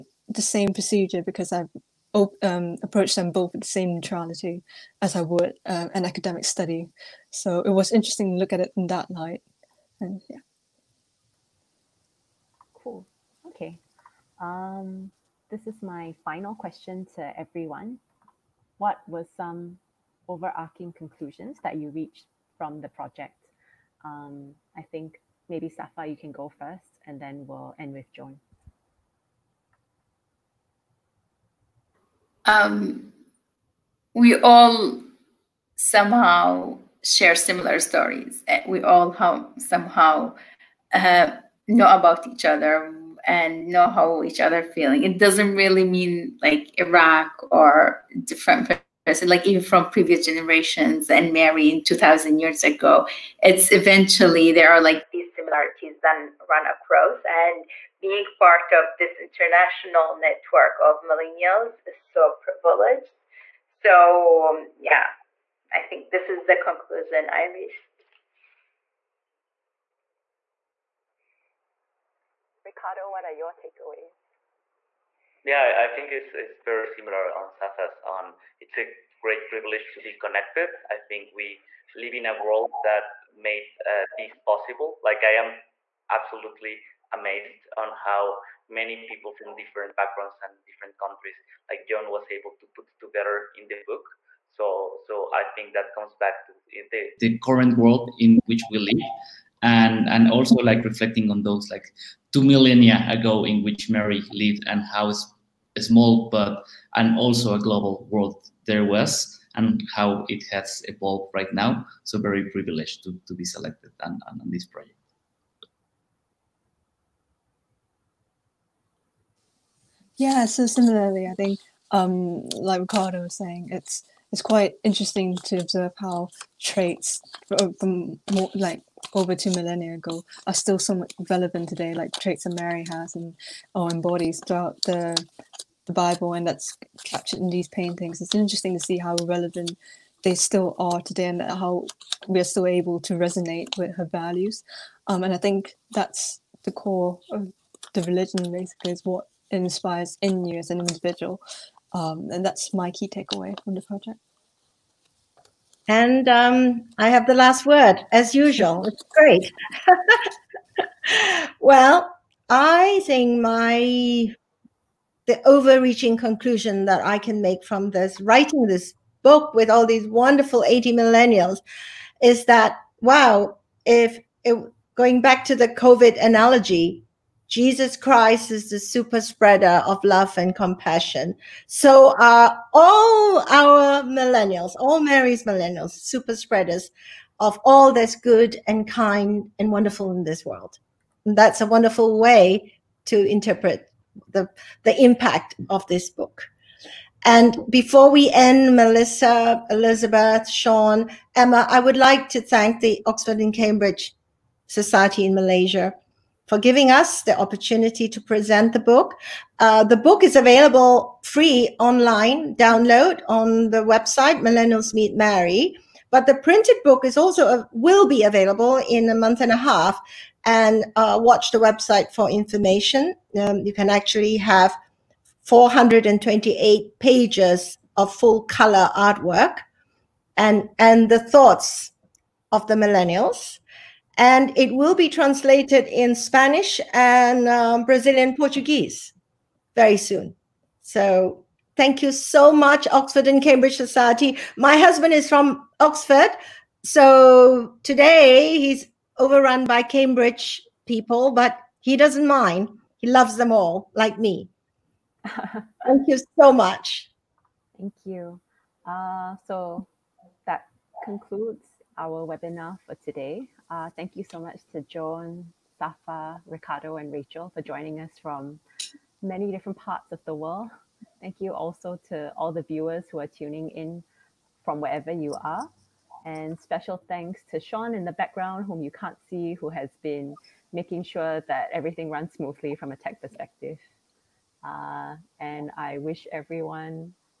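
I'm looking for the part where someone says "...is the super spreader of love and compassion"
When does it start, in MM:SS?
02:58.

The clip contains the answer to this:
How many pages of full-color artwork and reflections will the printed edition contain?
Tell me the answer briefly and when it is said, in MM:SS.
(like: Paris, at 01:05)
428, at 03:45.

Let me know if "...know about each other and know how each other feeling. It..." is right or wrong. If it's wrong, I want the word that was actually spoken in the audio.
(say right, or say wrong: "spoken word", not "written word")
right.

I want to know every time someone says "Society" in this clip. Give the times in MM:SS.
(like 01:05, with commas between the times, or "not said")
03:24, 04:03.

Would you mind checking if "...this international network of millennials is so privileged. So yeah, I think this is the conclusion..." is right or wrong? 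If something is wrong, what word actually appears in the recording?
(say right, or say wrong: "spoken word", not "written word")
right.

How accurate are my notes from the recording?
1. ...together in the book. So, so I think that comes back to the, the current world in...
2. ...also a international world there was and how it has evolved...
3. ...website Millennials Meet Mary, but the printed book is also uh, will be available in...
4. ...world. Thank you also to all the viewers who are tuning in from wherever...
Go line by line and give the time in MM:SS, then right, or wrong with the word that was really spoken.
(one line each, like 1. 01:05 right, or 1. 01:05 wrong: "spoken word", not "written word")
1. 01:32 right
2. 01:47 wrong: "global", not "international"
3. 03:33 right
4. 04:30 right.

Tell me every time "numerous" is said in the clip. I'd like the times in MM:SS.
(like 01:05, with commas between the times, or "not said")
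not said.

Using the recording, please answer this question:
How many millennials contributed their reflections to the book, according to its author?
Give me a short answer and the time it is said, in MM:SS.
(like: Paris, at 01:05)
80, at 02:50.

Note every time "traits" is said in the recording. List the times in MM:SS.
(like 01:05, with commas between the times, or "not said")
02:06, 02:12.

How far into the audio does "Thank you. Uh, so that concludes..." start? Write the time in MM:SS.
04:17.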